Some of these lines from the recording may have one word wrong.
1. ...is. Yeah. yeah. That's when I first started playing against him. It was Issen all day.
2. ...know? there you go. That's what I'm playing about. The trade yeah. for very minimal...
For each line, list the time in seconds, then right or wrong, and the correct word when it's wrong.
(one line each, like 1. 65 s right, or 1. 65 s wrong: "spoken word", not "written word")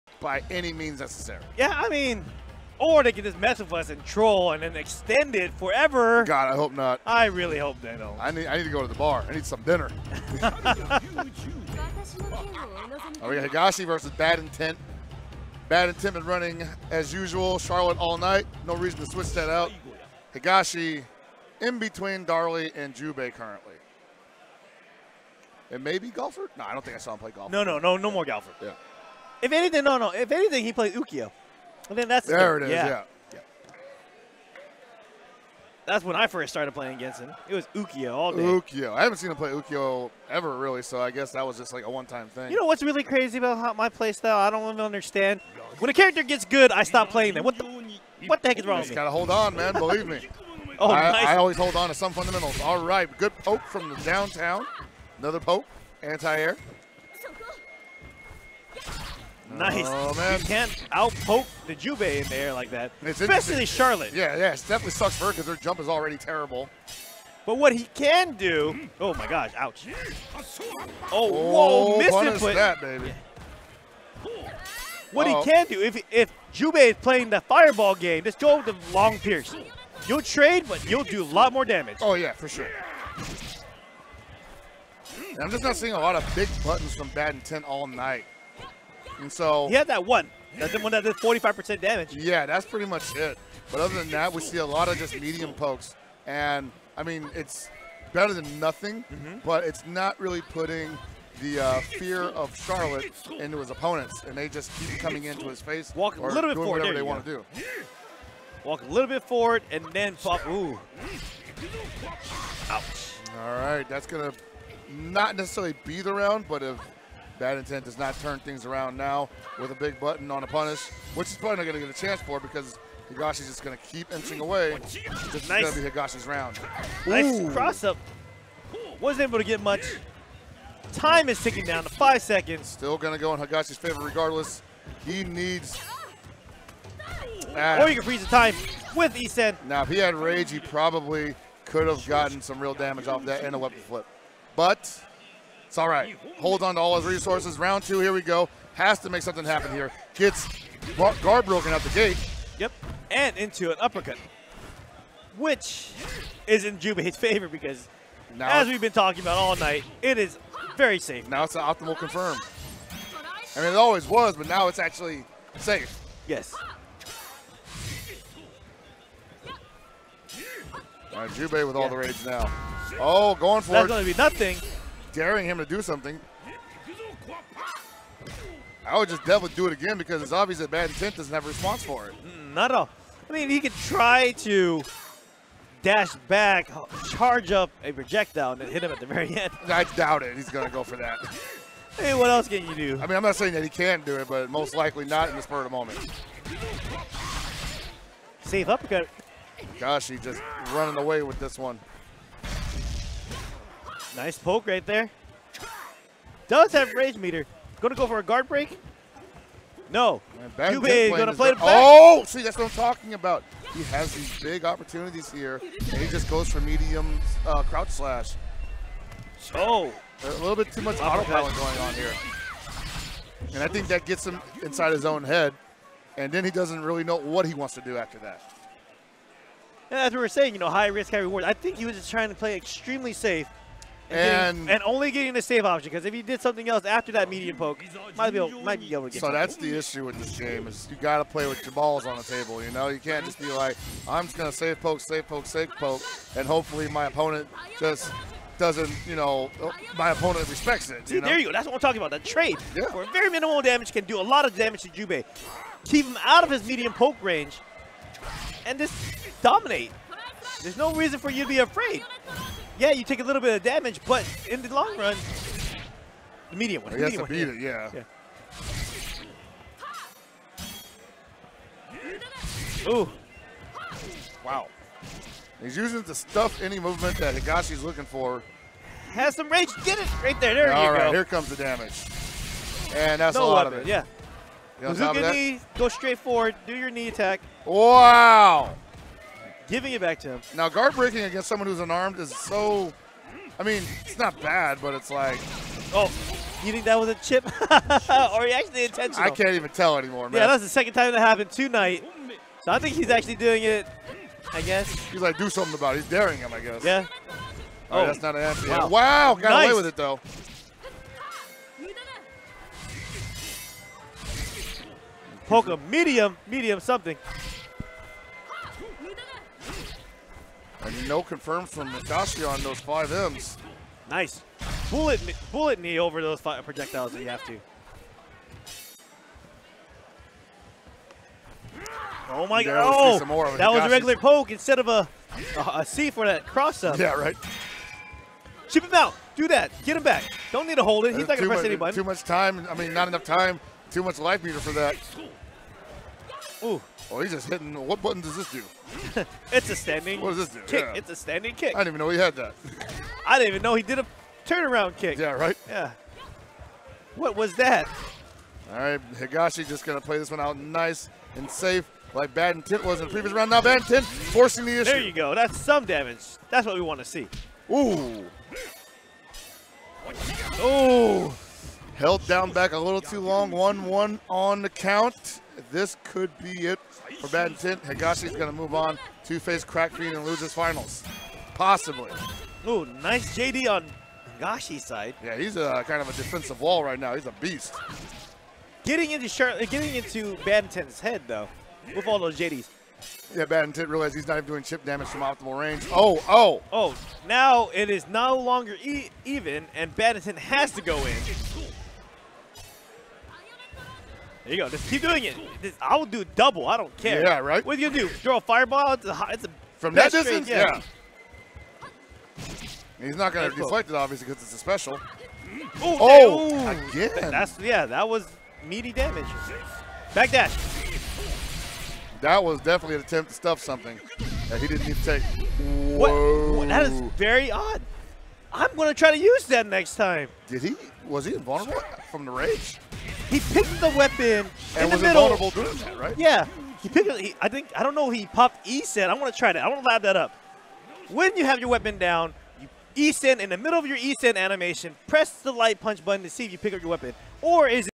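1. 32 s wrong: "Ukyo", not "Issen"
2. 251 s wrong: "talking", not "playing".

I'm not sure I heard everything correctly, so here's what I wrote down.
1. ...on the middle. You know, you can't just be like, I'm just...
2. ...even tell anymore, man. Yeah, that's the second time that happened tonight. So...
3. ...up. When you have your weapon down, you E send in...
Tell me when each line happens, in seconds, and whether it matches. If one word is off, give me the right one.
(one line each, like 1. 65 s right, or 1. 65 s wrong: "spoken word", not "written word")
1. 242 s wrong: "table", not "middle"
2. 299 s right
3. 440 s right.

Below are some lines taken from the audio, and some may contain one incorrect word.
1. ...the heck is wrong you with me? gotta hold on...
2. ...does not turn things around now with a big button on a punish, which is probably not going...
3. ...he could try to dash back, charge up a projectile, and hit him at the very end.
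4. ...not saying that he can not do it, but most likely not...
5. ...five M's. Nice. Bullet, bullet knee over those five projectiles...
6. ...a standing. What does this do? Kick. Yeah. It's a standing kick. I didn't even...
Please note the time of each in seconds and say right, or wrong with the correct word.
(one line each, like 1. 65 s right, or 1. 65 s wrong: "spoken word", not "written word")
1. 48 s right
2. 117 s right
3. 183 s right
4. 193 s right
5. 322 s right
6. 349 s right.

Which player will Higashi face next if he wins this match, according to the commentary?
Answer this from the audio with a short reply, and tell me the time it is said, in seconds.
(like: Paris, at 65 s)
Crack Fiend, at 379 s.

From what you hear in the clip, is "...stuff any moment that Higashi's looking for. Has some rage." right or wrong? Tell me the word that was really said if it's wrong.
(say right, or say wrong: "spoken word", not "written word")
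wrong: "movement", not "moment".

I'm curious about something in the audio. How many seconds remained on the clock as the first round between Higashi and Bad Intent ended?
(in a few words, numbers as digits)
5.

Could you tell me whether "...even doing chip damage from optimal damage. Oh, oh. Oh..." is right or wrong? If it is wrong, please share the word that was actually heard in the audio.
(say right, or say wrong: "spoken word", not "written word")
wrong: "range", not "damage".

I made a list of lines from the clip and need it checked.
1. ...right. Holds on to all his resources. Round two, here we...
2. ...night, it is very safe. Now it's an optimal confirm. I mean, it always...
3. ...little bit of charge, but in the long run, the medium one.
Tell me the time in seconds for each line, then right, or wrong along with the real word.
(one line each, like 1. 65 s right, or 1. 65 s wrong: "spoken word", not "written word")
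1. 145 s right
2. 159 s right
3. 263 s wrong: "damage", not "charge".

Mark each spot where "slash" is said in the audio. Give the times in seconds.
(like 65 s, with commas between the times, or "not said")
217 s.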